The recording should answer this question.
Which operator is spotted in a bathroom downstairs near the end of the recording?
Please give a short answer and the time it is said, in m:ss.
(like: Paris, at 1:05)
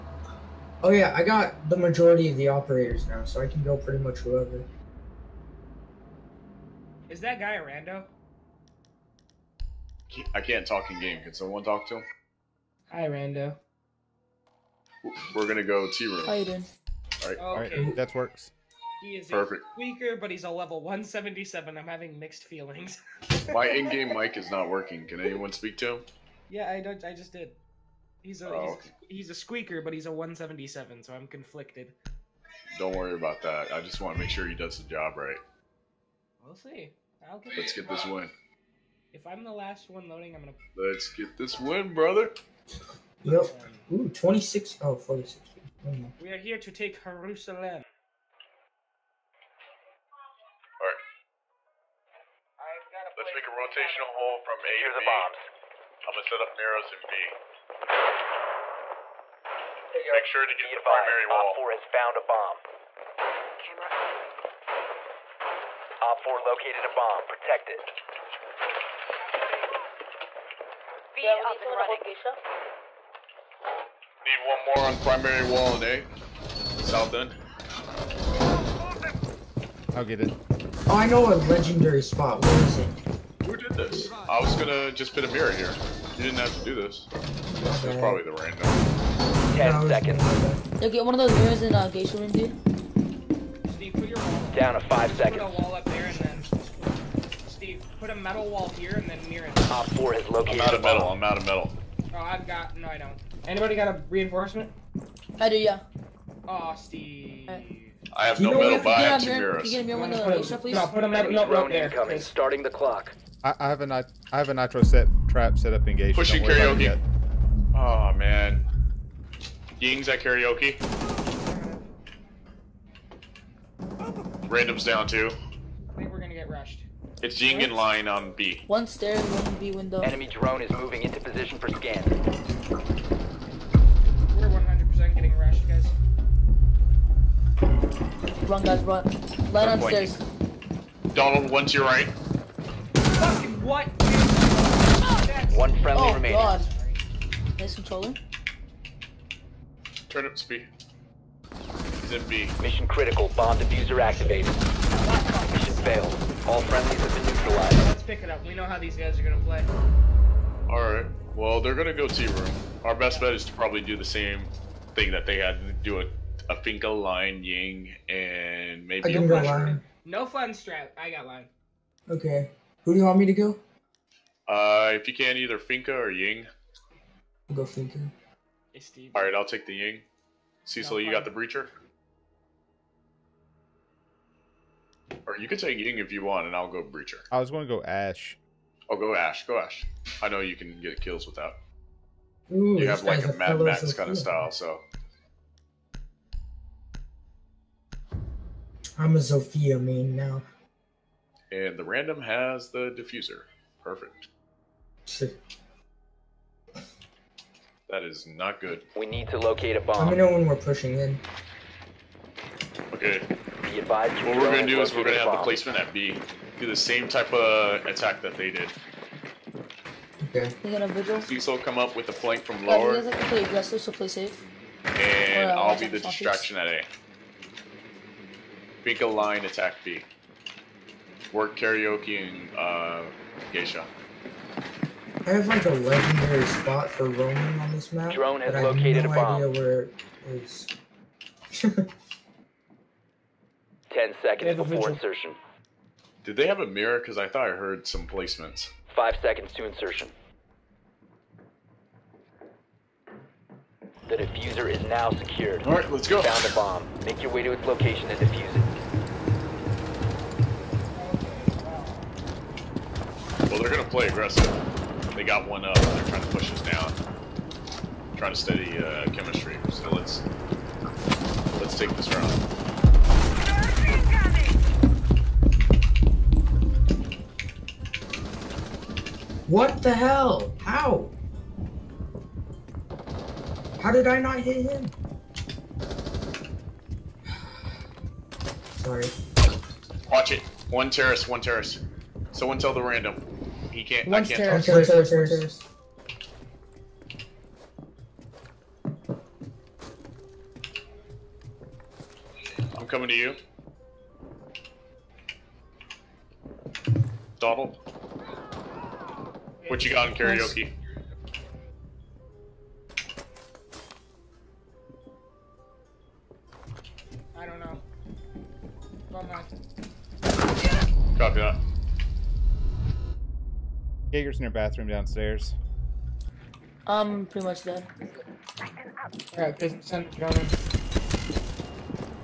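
Jaeger, at 5:24.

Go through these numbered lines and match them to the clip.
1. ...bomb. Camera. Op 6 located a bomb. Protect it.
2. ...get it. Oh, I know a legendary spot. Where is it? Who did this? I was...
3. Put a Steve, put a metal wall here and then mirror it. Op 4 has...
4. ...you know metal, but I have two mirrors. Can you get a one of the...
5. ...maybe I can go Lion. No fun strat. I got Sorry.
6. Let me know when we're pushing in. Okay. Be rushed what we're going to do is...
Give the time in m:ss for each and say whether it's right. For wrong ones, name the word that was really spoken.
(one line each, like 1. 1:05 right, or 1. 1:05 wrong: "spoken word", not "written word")
1. 1:02 wrong: "4", not "6"
2. 1:20 right
3. 1:35 right
4. 1:48 right
5. 2:48 wrong: "Lion", not "Sorry"
6. 3:29 wrong: "advised", not "rushed".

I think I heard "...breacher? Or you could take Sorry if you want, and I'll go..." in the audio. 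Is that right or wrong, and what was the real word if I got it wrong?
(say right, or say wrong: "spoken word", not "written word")
wrong: "Ying", not "Sorry".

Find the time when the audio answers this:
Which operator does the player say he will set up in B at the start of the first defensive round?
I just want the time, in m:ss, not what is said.
0:56.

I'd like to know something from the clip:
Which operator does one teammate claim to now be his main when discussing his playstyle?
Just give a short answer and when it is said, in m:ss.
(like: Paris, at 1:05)
Zofia, at 3:19.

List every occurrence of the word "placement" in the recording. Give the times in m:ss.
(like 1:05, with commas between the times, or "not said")
3:35, 4:08.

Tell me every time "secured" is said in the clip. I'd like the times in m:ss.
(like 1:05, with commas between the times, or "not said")
4:15.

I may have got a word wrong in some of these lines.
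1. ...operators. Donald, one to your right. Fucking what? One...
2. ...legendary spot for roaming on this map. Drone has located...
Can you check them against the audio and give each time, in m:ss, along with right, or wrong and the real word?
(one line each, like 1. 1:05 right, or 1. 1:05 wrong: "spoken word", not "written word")
1. 2:19 wrong: "stairs", not "operators"
2. 3:55 right.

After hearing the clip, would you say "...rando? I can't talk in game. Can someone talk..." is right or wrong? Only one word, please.
right.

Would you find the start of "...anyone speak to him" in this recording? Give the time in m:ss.
0:25.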